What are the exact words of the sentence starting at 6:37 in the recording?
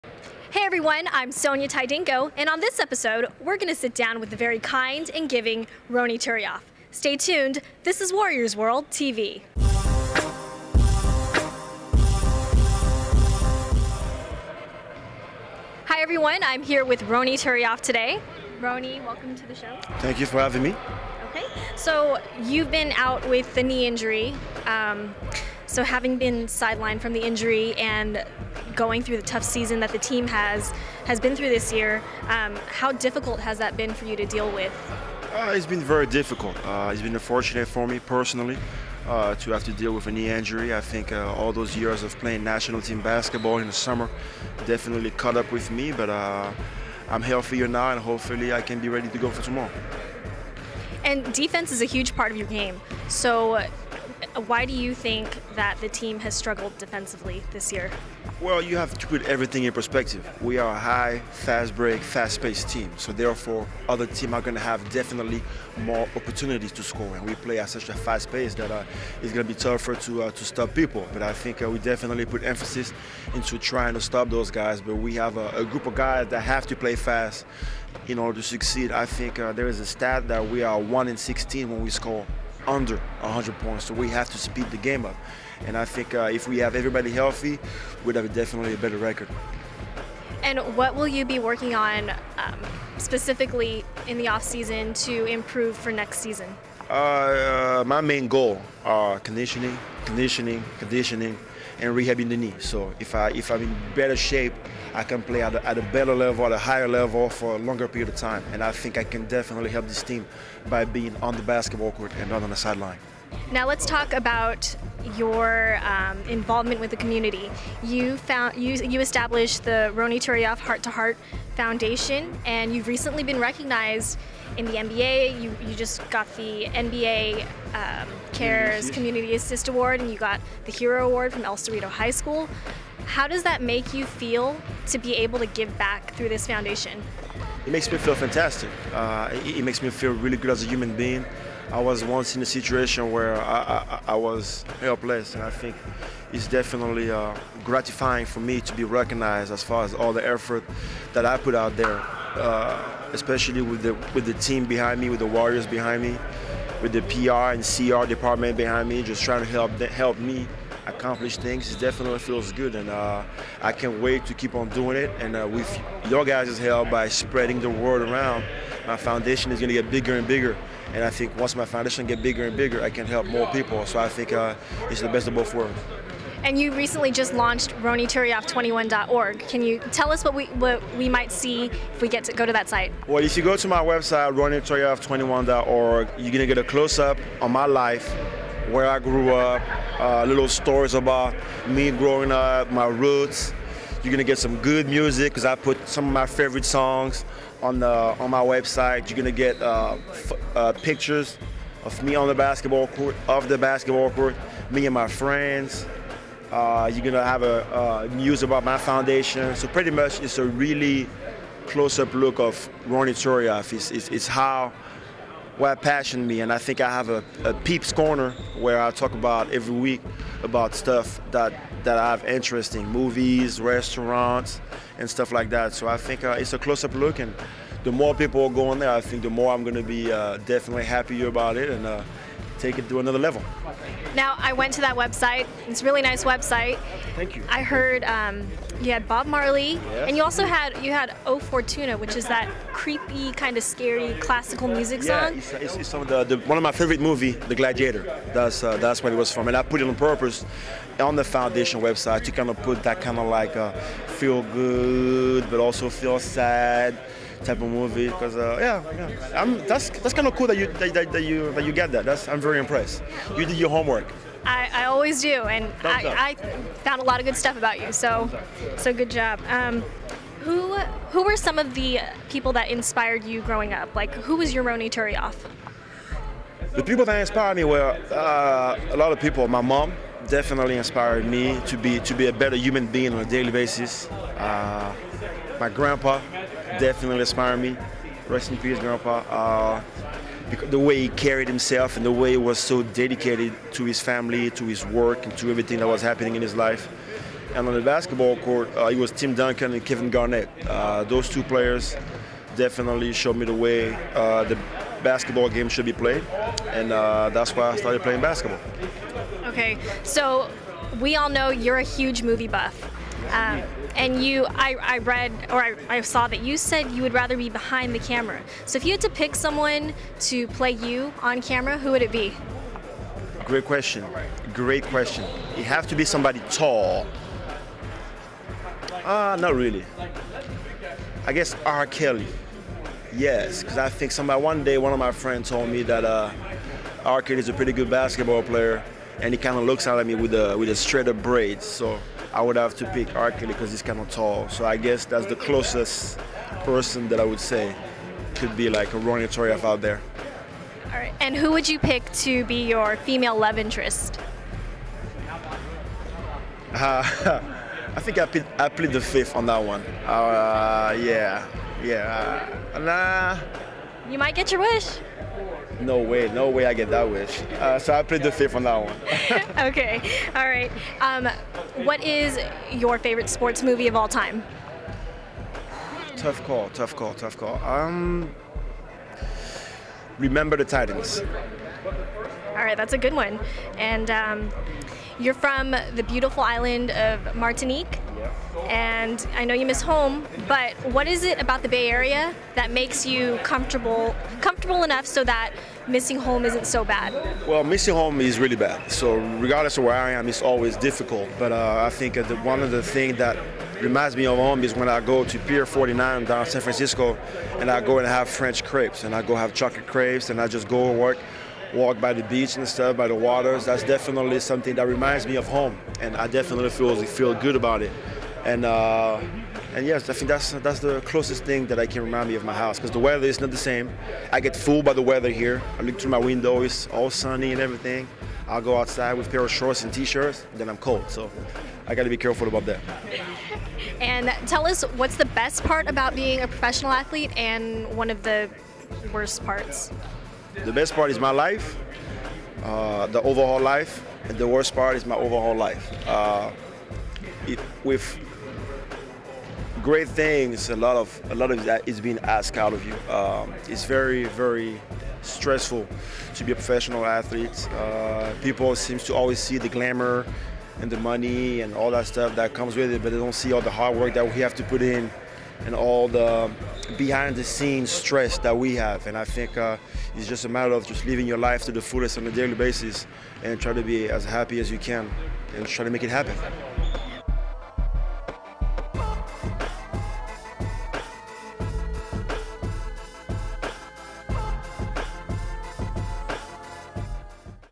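Well, missing home is really bad.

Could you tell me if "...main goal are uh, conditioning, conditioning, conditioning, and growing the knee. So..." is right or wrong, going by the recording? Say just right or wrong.
wrong.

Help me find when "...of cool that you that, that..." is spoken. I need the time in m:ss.
4:20.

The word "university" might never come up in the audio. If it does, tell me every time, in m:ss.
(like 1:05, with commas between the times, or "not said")
not said.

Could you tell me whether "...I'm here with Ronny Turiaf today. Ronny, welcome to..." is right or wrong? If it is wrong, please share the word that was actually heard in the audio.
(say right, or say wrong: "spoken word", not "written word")
right.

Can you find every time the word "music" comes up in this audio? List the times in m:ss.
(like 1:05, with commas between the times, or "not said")
3:14, 4:04.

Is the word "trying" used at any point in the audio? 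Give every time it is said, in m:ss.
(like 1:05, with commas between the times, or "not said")
1:13, 2:39.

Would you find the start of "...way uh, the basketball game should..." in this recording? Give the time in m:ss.
5:03.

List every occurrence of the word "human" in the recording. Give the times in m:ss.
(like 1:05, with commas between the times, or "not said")
2:20, 4:42.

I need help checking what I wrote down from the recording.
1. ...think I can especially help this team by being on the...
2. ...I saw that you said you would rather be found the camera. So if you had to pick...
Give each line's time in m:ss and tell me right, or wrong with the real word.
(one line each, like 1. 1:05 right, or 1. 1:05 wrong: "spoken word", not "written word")
1. 1:48 wrong: "definitely", not "especially"
2. 5:15 wrong: "behind", not "found".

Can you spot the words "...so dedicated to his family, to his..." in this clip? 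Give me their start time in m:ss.
4:52.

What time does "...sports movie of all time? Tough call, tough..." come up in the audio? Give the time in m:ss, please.
6:13.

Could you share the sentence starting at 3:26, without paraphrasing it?
Uh, you're gonna have a news about my foundation.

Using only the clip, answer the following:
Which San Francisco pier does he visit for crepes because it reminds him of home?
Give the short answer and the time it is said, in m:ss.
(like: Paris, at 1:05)
Pier 49, at 6:45.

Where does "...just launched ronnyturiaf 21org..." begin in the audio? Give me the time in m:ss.
2:57.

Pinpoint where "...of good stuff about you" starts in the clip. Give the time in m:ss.
4:27.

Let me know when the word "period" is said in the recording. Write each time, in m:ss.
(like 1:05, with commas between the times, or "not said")
1:47.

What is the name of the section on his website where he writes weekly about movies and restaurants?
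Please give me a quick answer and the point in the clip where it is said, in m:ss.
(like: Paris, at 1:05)
peeps corner, at 3:37.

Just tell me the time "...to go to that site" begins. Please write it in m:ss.
3:02.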